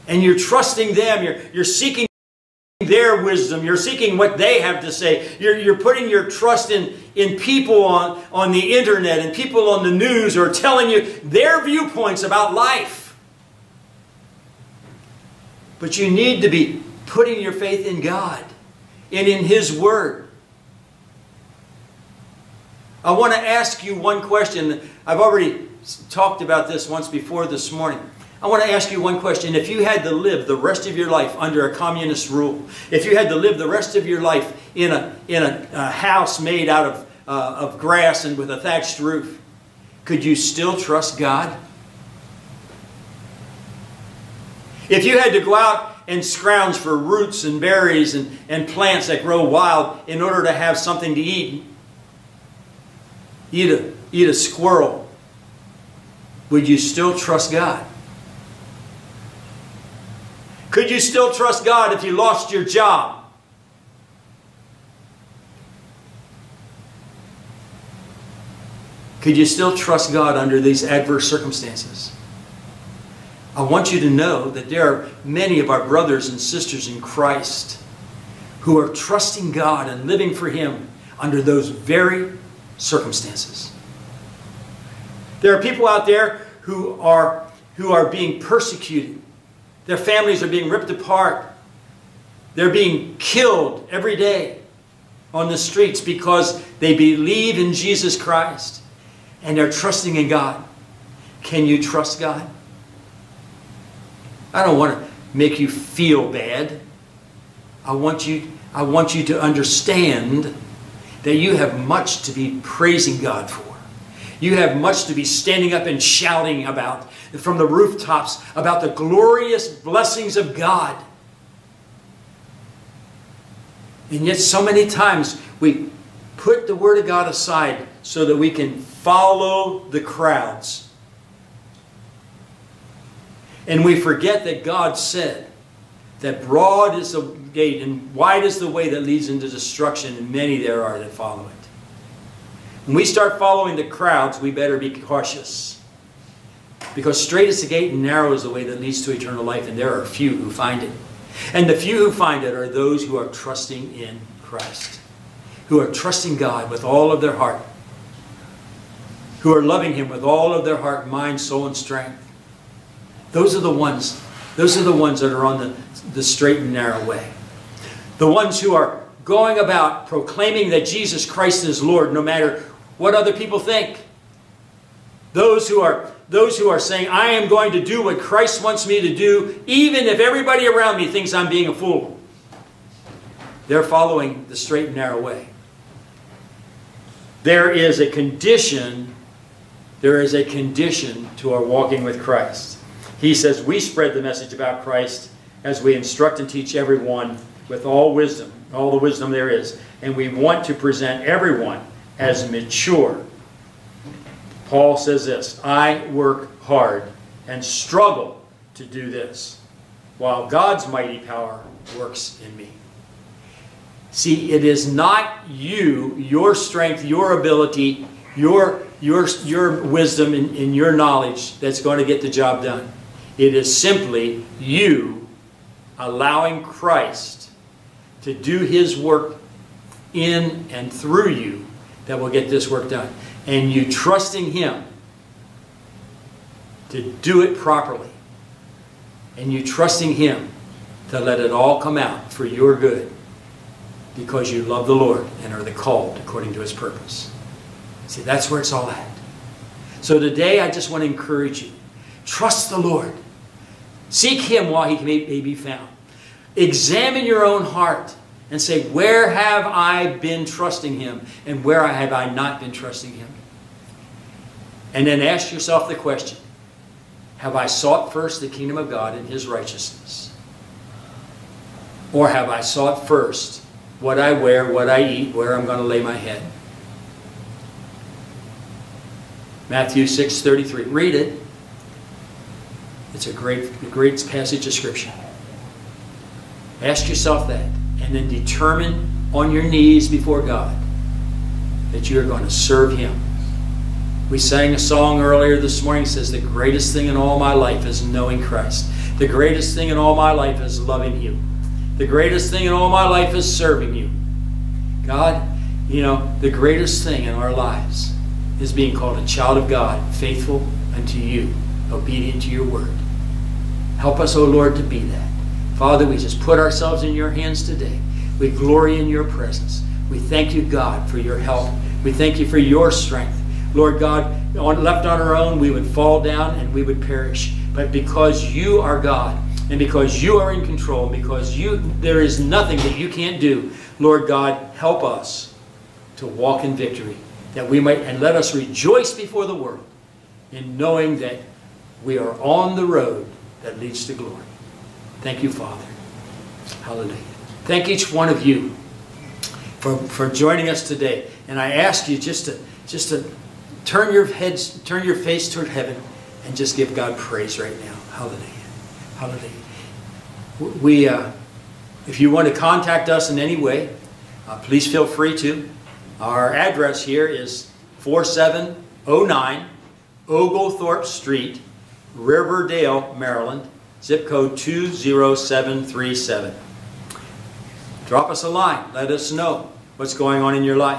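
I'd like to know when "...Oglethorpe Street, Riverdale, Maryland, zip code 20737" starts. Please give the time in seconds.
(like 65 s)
370 s.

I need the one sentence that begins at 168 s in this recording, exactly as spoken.
The ones who are going about proclaiming that Jesus Christ is Lord no matter what other people think.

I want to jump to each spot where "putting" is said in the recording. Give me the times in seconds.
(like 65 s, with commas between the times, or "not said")
5 s, 17 s.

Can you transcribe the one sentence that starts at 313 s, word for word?
Help us, O oh Lord, to be that.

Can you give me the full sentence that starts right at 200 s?
And we want to present everyone as mature.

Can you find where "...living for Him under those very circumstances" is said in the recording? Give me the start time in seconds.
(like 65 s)
80 s.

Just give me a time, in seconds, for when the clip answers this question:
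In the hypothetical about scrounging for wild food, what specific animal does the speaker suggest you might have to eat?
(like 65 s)
54 s.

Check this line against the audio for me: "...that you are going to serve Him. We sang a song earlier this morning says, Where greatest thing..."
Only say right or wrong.
wrong.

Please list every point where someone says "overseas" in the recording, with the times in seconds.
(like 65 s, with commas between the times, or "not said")
not said.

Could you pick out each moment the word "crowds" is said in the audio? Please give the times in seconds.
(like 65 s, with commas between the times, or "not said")
129 s, 143 s.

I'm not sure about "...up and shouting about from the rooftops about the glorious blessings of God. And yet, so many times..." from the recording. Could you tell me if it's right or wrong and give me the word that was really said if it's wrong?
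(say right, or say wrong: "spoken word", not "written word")
right.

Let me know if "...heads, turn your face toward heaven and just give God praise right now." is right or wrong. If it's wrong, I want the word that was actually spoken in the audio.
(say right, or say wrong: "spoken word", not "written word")
right.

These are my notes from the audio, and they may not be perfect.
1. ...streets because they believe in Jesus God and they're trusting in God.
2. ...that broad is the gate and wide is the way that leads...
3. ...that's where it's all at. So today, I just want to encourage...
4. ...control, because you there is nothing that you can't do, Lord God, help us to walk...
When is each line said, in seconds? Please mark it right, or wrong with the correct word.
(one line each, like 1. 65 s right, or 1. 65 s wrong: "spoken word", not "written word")
1. 95 s wrong: "Christ", not "God"
2. 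136 s right
3. 248 s right
4. 330 s right.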